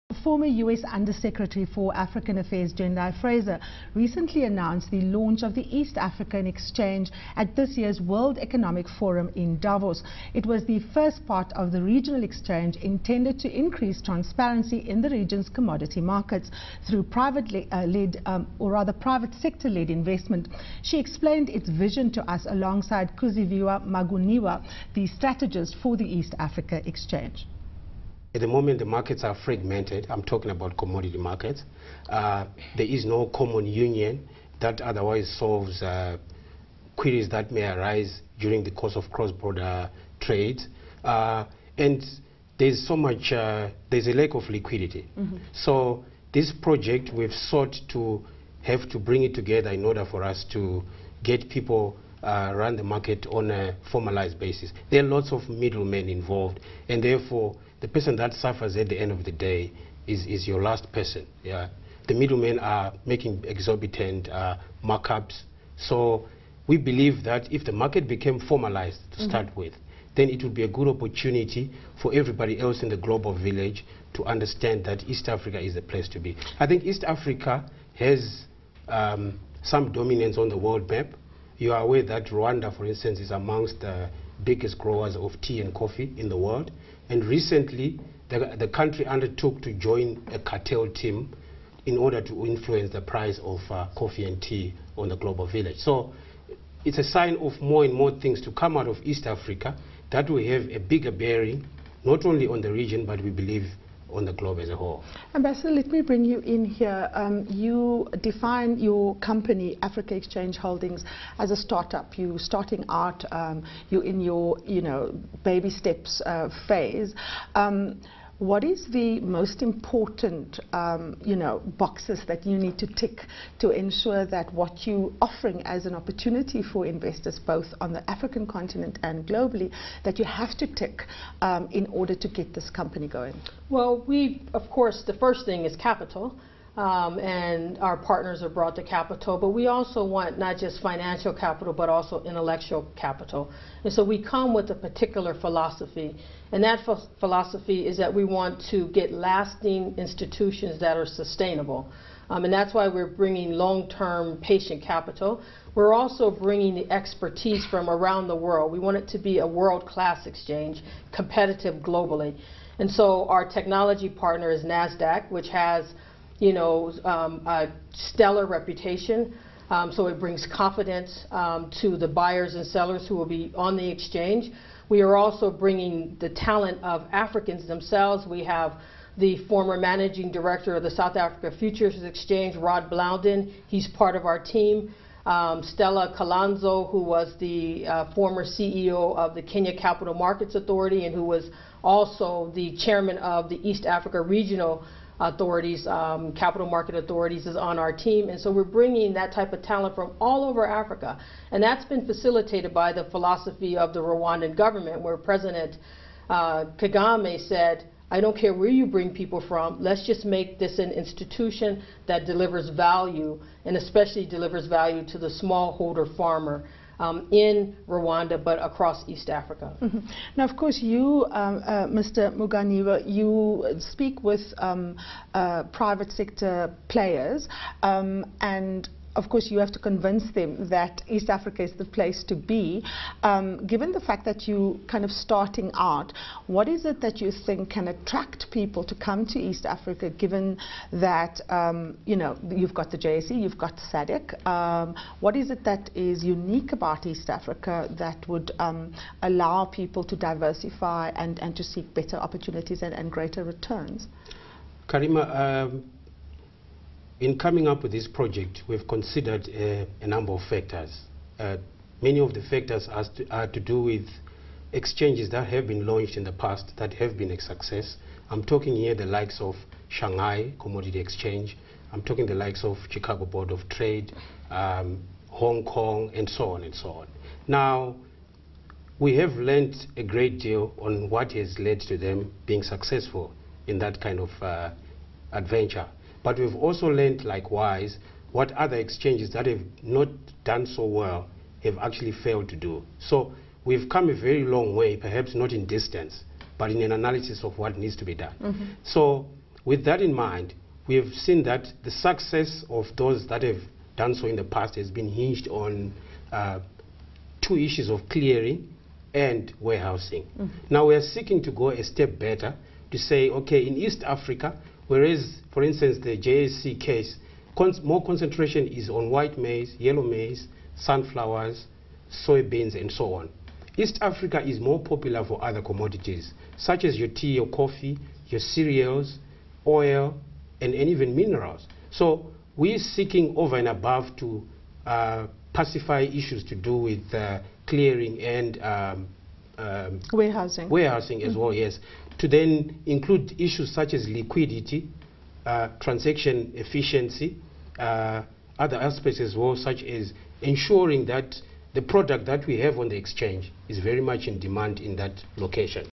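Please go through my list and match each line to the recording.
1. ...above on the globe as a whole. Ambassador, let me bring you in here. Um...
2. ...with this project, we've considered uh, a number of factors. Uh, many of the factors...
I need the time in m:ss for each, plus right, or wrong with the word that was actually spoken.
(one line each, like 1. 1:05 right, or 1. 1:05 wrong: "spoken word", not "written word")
1. 1:43 wrong: "believe", not "above"
2. 4:17 right.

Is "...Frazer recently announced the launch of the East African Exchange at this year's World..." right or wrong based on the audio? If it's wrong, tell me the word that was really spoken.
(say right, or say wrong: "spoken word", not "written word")
right.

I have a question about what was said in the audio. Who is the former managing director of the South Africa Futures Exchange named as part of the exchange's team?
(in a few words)
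Rod Blondin.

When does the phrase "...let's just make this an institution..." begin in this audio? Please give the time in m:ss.
3:29.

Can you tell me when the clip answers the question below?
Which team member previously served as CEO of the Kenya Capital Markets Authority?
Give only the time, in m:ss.
3:05.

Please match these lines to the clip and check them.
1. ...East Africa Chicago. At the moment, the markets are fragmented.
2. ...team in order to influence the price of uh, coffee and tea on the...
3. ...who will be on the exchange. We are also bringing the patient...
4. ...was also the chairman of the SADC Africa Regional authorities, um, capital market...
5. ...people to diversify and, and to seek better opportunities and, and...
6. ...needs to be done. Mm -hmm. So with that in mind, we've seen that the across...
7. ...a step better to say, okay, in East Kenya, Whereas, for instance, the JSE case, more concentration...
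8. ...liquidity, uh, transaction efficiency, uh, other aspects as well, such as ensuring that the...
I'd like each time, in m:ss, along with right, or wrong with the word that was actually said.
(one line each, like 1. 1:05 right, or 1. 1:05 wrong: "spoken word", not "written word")
1. 0:26 wrong: "Exchange", not "Chicago"
2. 1:30 right
3. 2:53 wrong: "talent", not "patient"
4. 3:11 wrong: "East", not "SADC"
5. 4:09 right
6. 4:57 wrong: "success", not "across"
7. 5:11 wrong: "Africa", not "Kenya"
8. 5:44 right.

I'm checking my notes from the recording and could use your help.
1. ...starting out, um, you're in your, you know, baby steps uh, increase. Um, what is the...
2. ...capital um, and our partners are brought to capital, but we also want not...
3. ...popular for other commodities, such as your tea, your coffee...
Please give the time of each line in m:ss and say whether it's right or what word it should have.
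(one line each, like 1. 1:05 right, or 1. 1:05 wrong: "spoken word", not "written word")
1. 1:52 wrong: "phase", not "increase"
2. 2:15 right
3. 5:24 right.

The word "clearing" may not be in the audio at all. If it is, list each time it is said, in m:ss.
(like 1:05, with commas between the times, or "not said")
5:08, 5:37.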